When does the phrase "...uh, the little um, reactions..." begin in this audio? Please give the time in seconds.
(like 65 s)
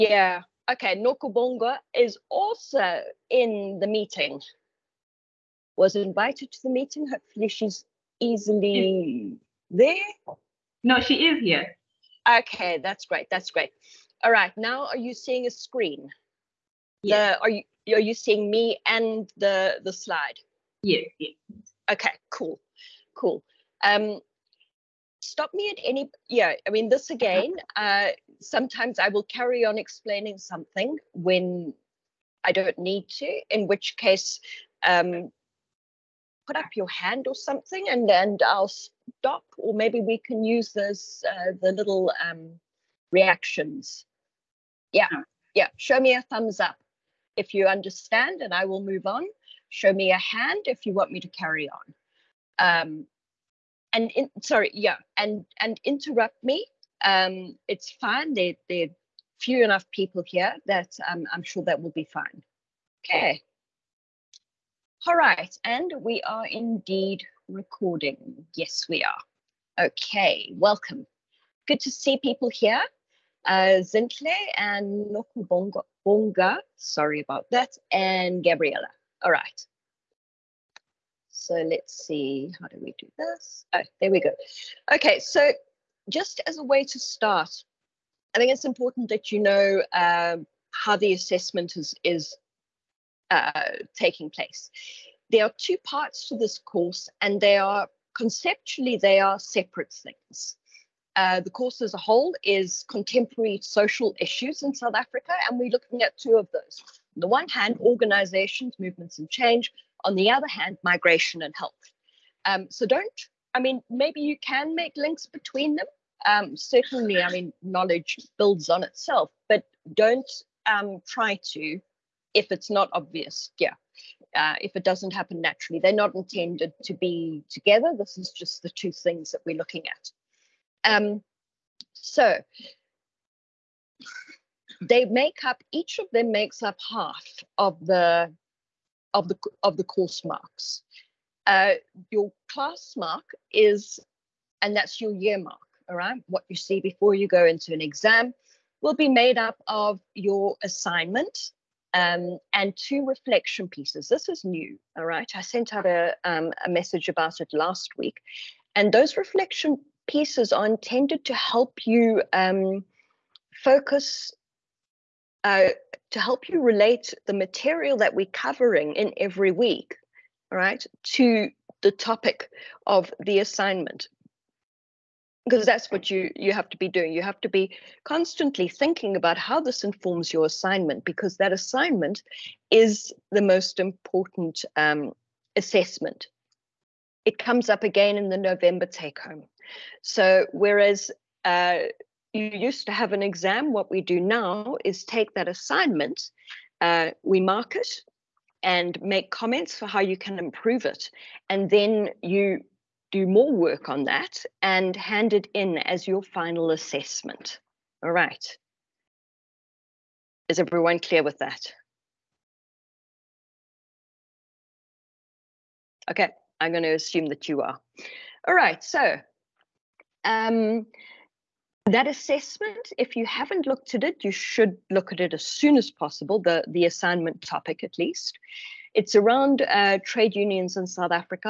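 41 s.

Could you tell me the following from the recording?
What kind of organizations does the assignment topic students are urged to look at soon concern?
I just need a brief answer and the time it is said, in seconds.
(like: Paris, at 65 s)
Trade unions, at 230 s.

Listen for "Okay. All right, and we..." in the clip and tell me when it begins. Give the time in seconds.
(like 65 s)
63 s.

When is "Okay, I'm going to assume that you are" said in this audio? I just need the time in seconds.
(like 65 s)
216 s.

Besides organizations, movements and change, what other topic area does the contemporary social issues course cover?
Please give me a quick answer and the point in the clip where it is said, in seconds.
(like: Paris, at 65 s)
Migration and health, at 110 s.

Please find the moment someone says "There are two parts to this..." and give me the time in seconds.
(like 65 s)
95 s.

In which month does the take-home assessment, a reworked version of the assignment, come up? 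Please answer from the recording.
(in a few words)
November.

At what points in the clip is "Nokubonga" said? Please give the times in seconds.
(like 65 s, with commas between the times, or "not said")
0 s, 75 s.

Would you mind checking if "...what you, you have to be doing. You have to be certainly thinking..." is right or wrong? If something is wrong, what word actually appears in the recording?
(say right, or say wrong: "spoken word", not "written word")
wrong: "constantly", not "certainly".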